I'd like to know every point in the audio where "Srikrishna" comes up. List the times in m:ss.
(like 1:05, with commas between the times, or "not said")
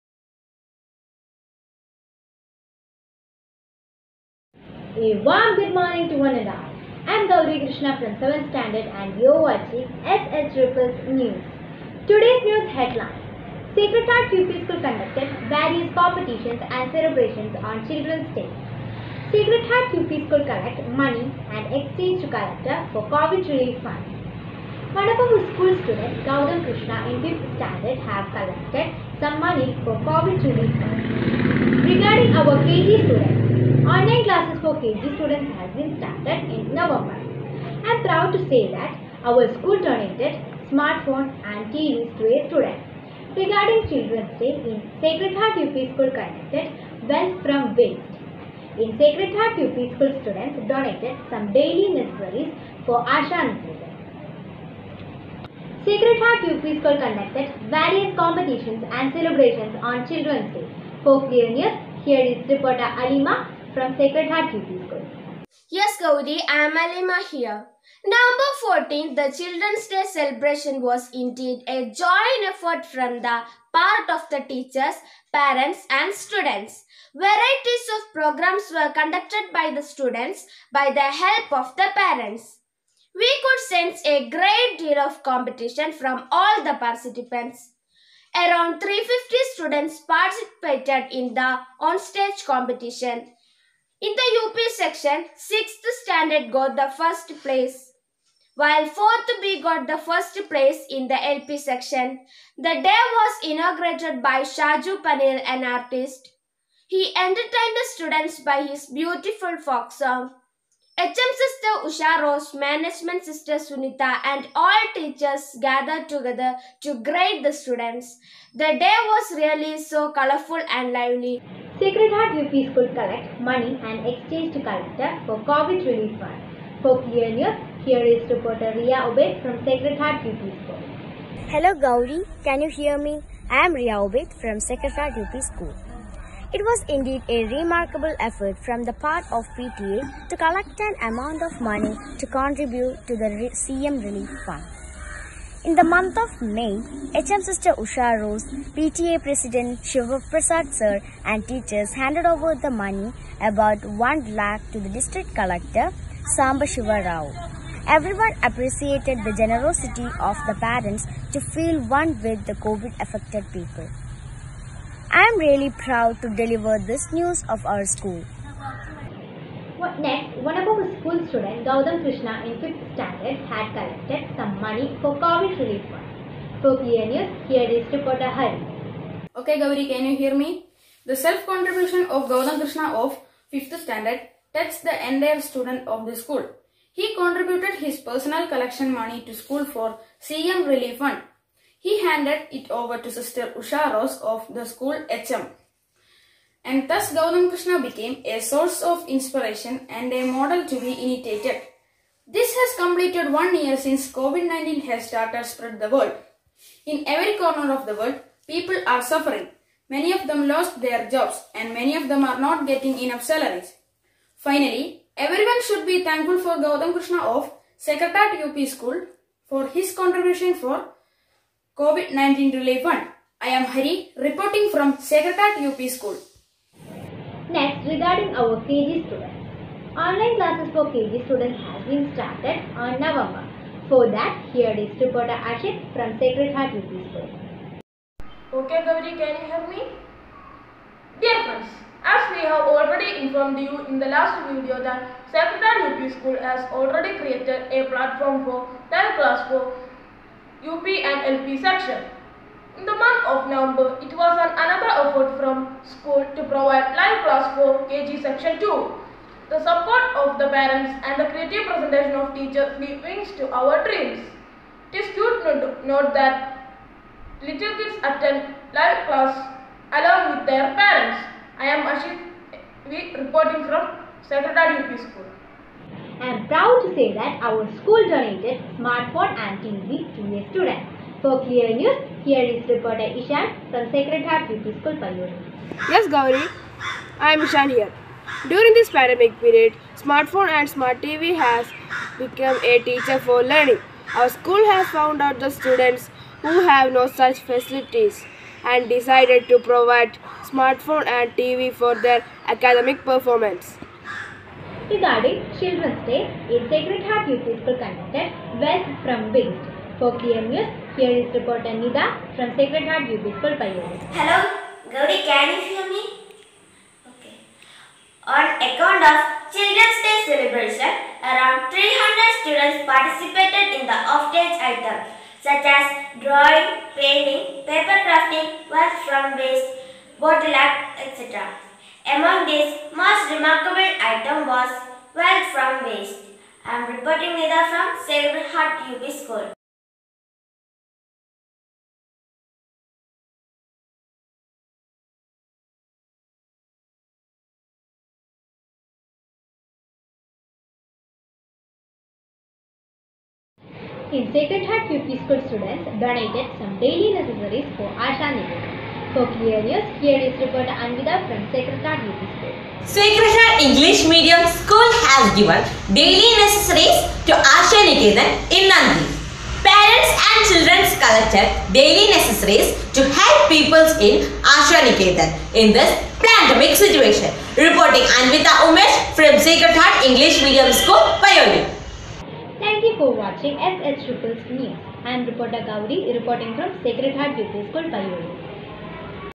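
6:02.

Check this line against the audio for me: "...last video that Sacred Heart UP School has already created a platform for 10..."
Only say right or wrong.
right.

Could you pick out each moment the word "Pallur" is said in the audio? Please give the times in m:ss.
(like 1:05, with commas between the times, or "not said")
4:45.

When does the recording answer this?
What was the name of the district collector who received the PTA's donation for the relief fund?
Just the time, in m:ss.
2:36.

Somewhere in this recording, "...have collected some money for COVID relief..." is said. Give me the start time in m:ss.
0:28.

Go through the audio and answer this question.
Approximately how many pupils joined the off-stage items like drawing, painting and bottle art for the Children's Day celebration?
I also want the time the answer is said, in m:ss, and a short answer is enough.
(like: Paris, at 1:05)
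300, at 5:21.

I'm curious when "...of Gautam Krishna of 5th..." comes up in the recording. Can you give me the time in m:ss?
3:02.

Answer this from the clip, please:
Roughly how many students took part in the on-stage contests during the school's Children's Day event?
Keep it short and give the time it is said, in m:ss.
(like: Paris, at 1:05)
350, at 1:28.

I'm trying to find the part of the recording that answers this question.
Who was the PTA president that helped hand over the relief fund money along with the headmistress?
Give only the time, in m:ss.
2:29.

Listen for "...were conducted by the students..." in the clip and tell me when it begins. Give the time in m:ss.
1:18.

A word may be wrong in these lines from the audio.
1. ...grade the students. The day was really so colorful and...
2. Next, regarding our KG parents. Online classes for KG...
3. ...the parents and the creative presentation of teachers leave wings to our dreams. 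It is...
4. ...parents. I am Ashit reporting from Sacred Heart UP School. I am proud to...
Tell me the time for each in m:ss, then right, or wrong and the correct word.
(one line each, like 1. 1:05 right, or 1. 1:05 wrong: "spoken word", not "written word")
1. 1:57 right
2. 3:47 wrong: "students", not "parents"
3. 4:20 right
4. 4:30 right.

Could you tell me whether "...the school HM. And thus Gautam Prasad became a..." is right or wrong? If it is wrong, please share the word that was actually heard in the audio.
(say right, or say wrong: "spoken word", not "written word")
wrong: "Krishna", not "Prasad".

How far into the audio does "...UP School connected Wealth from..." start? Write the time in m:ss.
0:45.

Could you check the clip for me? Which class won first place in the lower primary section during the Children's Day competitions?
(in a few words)
4th B.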